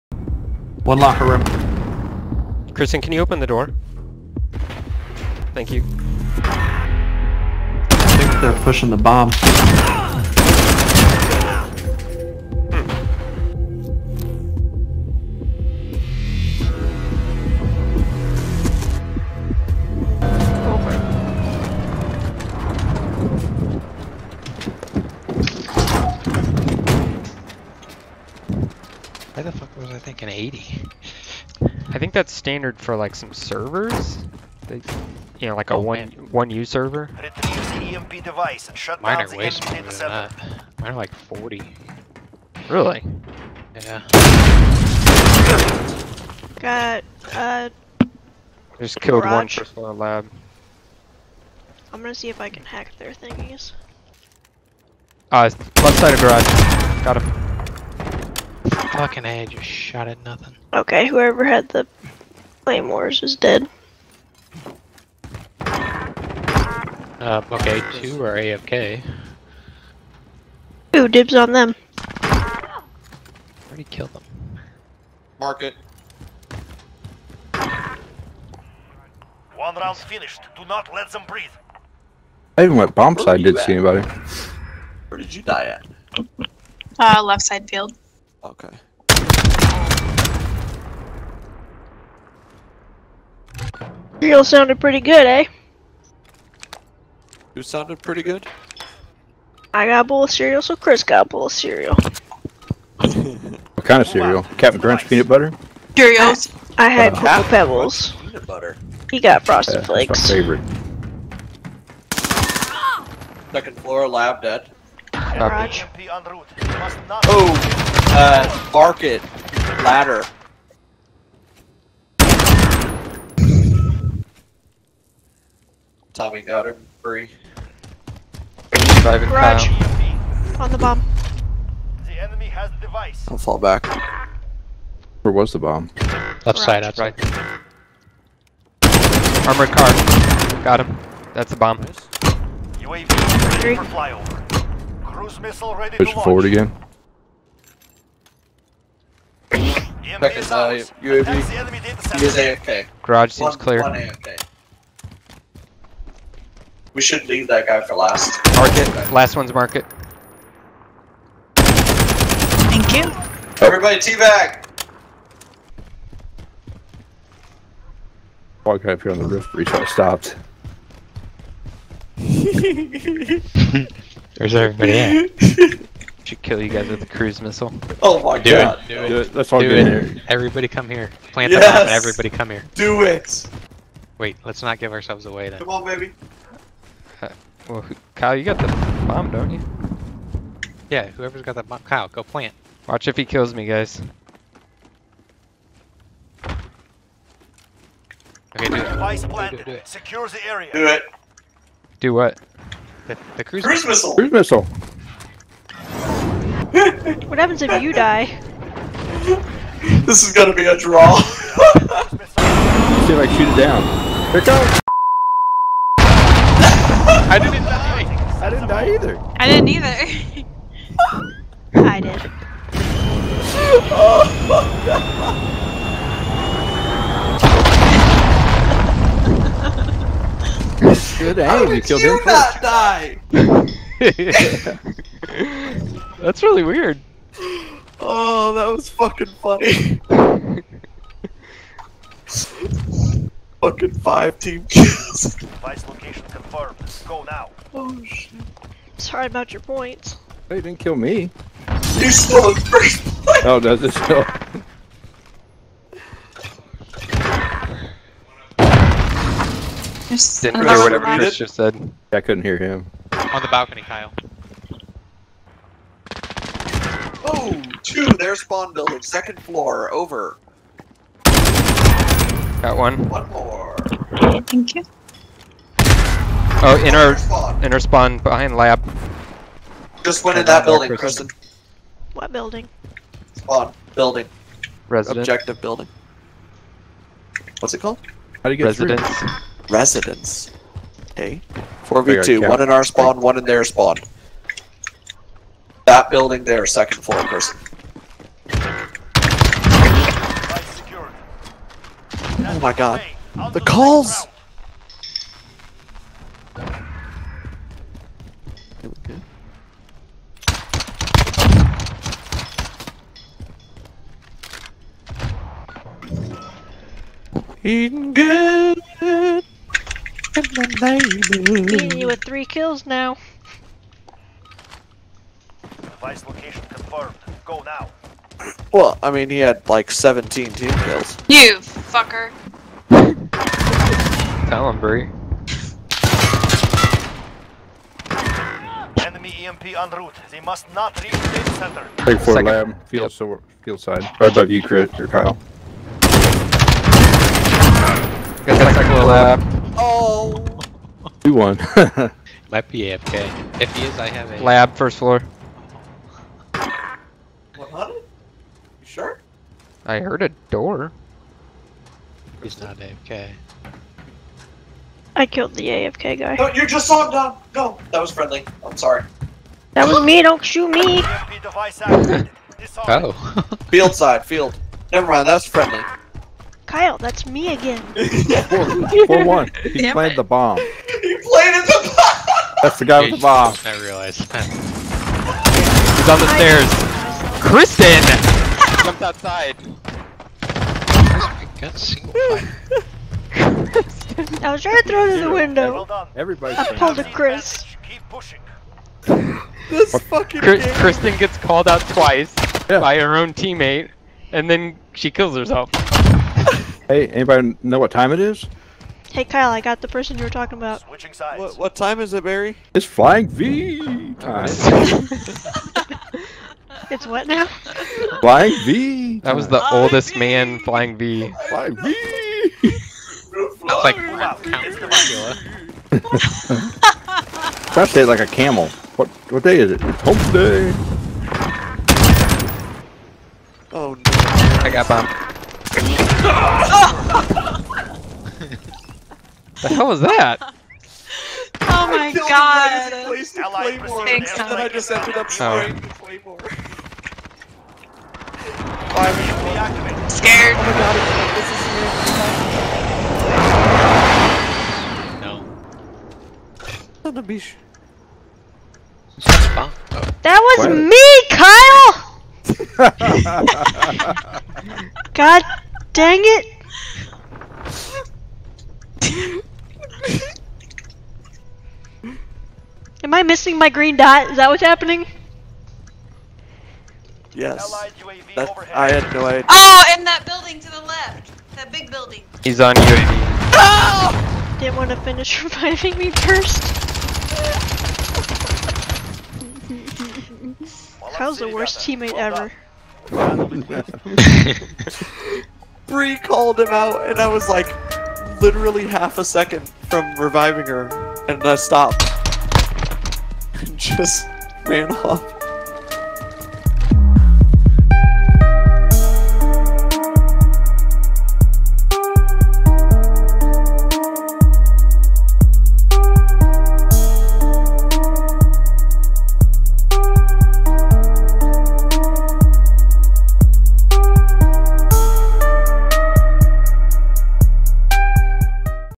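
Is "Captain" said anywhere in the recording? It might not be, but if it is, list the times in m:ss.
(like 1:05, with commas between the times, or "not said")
1:44.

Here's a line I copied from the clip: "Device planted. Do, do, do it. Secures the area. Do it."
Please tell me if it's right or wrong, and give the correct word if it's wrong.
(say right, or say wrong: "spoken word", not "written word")
right.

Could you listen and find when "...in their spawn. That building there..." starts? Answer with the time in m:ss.
4:53.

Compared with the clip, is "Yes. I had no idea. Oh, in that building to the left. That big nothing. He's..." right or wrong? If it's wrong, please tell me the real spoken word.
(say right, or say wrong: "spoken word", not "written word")
wrong: "building", not "nothing".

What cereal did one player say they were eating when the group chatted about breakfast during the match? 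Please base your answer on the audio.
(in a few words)
Cheerios.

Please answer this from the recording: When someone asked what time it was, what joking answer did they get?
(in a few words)
Flying V time.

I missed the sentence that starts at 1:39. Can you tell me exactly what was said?
I got a bowl of cereal, so Chris got a bowl of cereal.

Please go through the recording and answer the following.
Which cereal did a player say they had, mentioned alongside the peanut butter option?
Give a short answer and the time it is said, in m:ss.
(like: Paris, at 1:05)
Pebbles, at 1:47.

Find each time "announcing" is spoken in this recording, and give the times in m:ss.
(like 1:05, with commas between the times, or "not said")
not said.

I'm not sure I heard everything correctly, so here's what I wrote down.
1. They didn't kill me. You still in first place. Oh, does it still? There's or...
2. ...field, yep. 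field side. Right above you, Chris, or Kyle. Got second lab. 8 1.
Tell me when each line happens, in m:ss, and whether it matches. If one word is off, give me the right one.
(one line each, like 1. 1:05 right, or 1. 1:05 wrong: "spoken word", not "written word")
1. 4:10 right
2. 5:42 wrong: "2", not "8".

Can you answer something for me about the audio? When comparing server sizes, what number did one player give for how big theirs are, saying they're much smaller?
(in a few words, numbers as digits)
40.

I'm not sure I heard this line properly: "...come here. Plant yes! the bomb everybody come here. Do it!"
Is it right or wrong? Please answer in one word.
right.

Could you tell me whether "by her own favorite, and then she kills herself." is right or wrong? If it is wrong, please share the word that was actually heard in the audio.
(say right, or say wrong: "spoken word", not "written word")
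wrong: "teammate", not "favorite".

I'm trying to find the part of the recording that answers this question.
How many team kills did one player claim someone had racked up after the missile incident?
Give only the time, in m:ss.
4:03.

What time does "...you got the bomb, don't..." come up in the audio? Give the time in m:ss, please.
3:08.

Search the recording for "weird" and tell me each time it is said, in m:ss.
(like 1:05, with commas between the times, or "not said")
3:56, 7:35.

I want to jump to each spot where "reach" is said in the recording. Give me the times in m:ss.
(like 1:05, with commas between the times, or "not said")
2:49, 5:41.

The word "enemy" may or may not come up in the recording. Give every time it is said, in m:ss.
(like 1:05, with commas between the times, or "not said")
2:12, 5:39.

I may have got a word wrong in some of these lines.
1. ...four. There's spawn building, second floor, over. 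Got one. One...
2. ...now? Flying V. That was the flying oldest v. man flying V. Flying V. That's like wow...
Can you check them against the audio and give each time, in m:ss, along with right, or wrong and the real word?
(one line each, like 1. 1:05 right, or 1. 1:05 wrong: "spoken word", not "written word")
1. 4:27 wrong: "two", not "four"
2. 6:57 right.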